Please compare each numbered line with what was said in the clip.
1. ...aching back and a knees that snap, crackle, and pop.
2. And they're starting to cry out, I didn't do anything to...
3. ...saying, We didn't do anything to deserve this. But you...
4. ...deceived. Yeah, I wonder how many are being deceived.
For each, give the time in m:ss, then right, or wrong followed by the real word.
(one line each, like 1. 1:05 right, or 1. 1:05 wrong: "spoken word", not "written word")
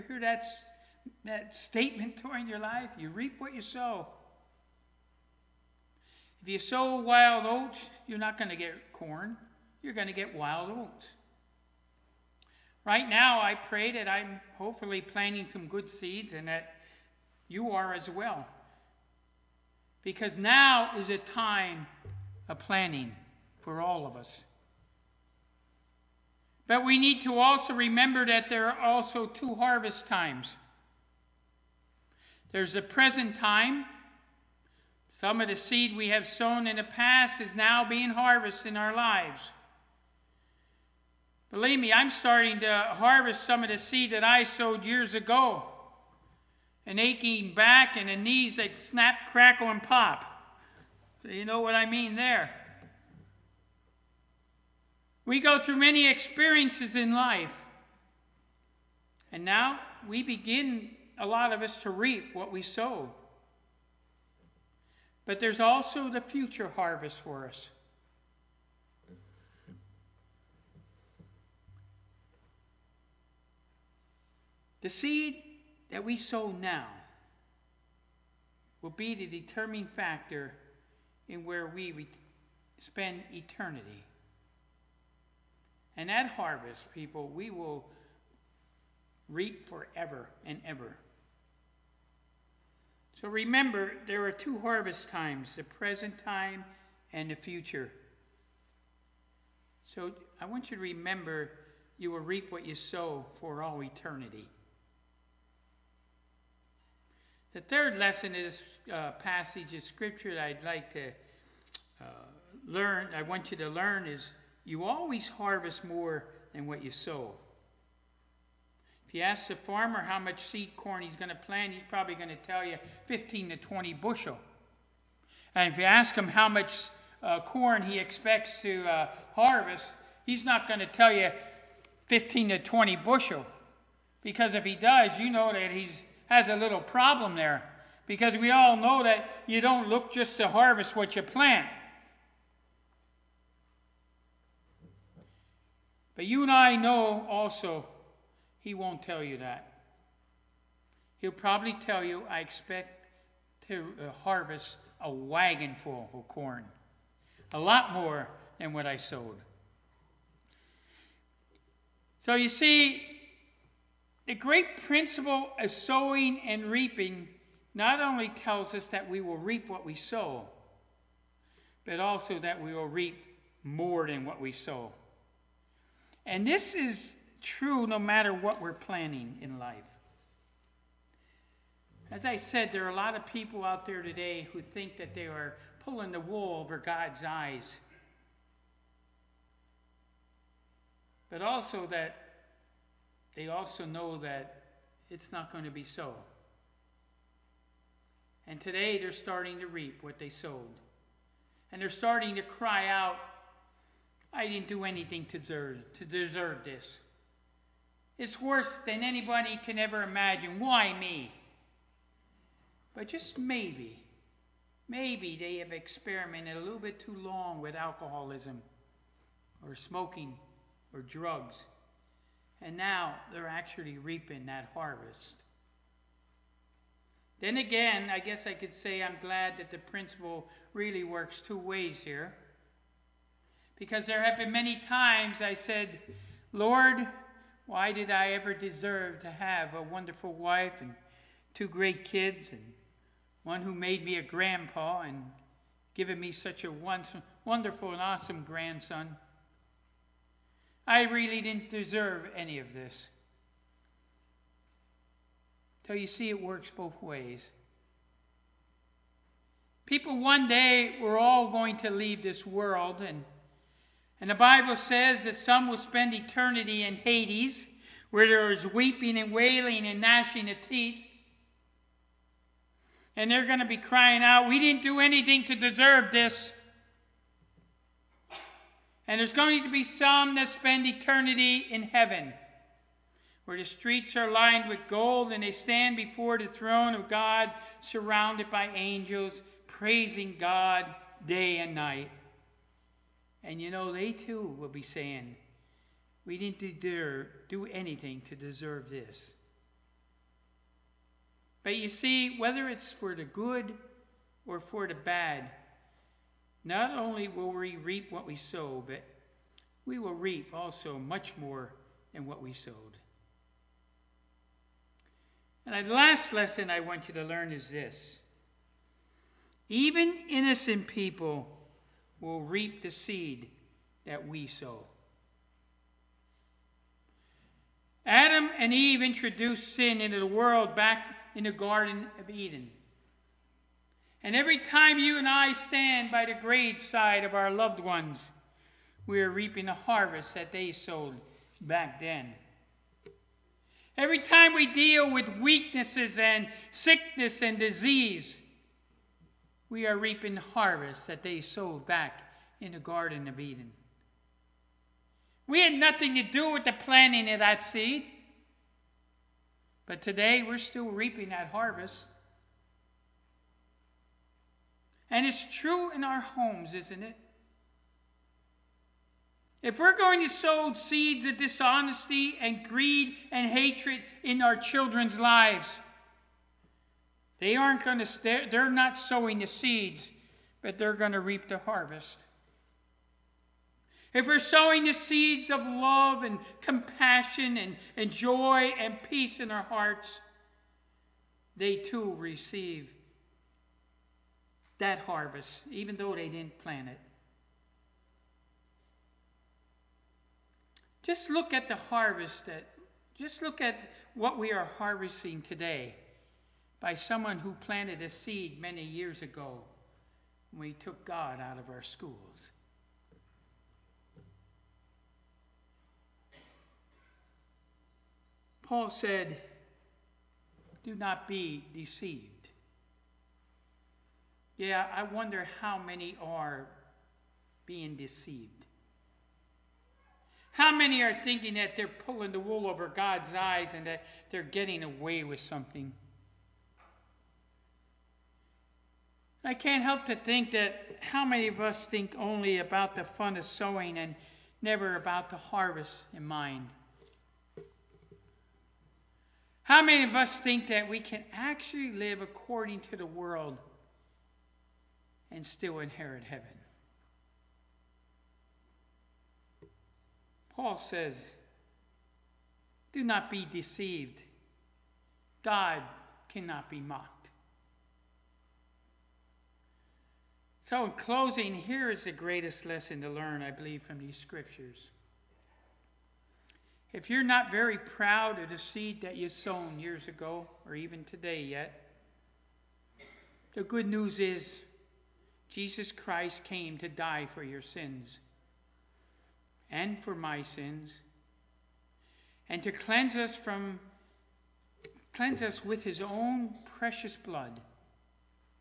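1. 0:46 right
2. 3:21 right
3. 4:54 right
4. 7:01 right.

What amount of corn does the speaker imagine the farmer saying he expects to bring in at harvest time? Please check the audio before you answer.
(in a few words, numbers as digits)
A wagon full.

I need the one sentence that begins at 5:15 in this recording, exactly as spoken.
And the last lesson I want you to learn is this even innocent people will reap the seed that we sow.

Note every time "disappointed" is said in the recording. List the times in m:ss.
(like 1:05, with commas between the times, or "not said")
not said.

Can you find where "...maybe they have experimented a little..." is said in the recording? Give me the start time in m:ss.
3:34.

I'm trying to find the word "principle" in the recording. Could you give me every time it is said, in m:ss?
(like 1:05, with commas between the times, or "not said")
2:44, 3:49.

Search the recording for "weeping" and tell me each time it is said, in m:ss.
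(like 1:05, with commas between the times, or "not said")
4:28.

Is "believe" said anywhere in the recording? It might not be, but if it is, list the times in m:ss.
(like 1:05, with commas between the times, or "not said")
0:41, 7:53.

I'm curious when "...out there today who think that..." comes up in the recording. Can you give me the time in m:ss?
3:03.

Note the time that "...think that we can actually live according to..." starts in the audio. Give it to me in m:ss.
7:30.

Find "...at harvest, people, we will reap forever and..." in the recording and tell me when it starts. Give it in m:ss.
1:26.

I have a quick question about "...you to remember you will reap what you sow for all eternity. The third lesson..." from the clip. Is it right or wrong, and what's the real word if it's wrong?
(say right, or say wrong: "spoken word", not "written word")
right.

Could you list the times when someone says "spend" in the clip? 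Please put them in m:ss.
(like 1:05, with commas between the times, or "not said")
1:22, 4:25, 4:40.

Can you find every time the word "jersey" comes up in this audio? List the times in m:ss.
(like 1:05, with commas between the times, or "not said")
not said.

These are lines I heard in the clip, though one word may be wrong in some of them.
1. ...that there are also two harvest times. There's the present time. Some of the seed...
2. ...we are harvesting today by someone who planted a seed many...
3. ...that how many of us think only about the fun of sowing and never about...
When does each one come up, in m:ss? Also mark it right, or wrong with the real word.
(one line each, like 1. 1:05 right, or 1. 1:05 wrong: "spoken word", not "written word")
1. 0:28 right
2. 6:44 right
3. 7:20 right.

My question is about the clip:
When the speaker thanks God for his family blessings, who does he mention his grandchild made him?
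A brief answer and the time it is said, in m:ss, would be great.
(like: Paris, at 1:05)
A grandpa, at 4:04.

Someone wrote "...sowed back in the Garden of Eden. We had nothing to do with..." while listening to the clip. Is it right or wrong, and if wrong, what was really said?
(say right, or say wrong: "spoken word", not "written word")
right.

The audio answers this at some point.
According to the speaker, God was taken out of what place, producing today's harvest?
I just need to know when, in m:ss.
6:51.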